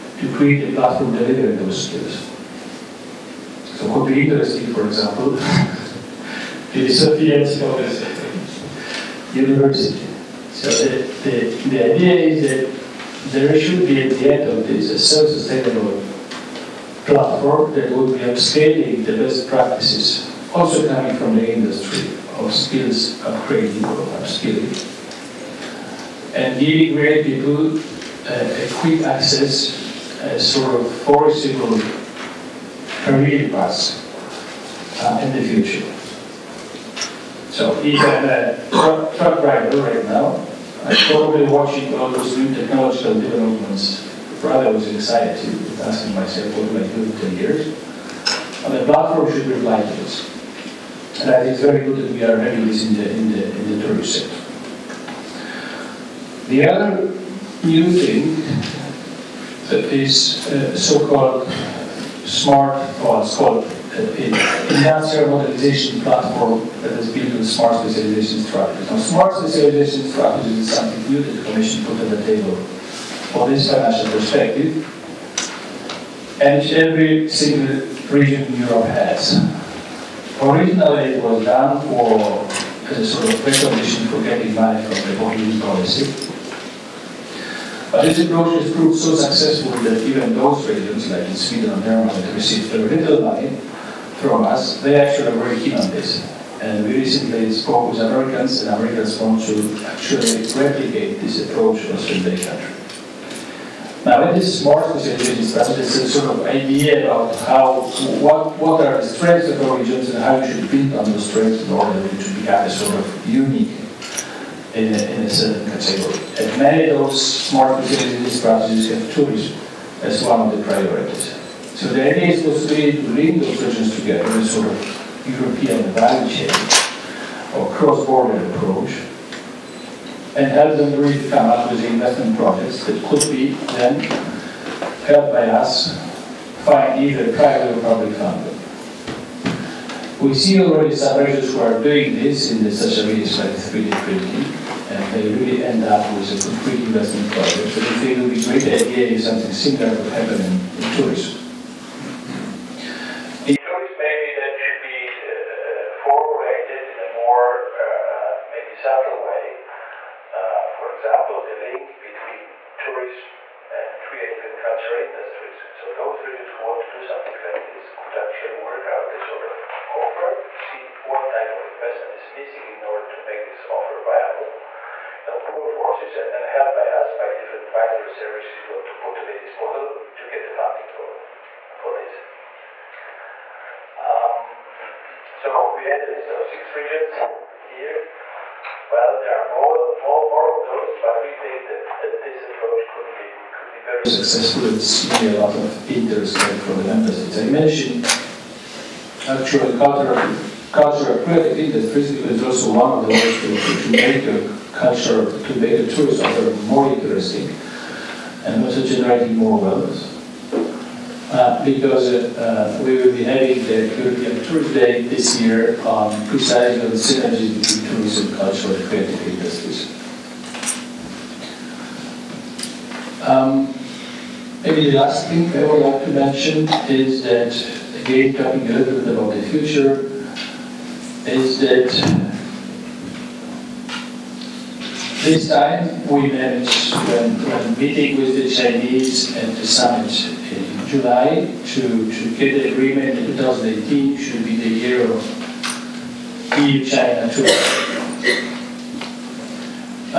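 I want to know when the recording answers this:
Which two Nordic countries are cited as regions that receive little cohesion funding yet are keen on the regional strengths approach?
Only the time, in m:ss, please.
1:31.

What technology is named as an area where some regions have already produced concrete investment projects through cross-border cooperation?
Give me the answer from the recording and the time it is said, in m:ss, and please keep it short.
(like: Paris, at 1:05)
3D printing, at 2:23.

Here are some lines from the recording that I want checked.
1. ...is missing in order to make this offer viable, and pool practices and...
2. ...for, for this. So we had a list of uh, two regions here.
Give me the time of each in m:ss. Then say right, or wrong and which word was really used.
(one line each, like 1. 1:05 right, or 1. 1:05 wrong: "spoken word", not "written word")
1. 2:52 wrong: "forces", not "practices"
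2. 3:00 wrong: "six", not "two".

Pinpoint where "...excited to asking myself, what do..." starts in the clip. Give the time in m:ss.
0:44.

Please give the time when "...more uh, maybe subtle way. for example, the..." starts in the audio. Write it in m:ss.
2:37.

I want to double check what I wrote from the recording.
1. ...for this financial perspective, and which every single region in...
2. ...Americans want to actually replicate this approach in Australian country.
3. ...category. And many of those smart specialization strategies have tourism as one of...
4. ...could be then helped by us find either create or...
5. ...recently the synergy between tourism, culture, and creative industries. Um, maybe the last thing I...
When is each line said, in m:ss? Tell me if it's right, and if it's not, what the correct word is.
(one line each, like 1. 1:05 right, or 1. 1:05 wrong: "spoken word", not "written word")
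1. 1:13 right
2. 1:38 right
3. 1:55 right
4. 2:13 wrong: "private", not "create"
5. 3:36 wrong: "precisely", not "recently".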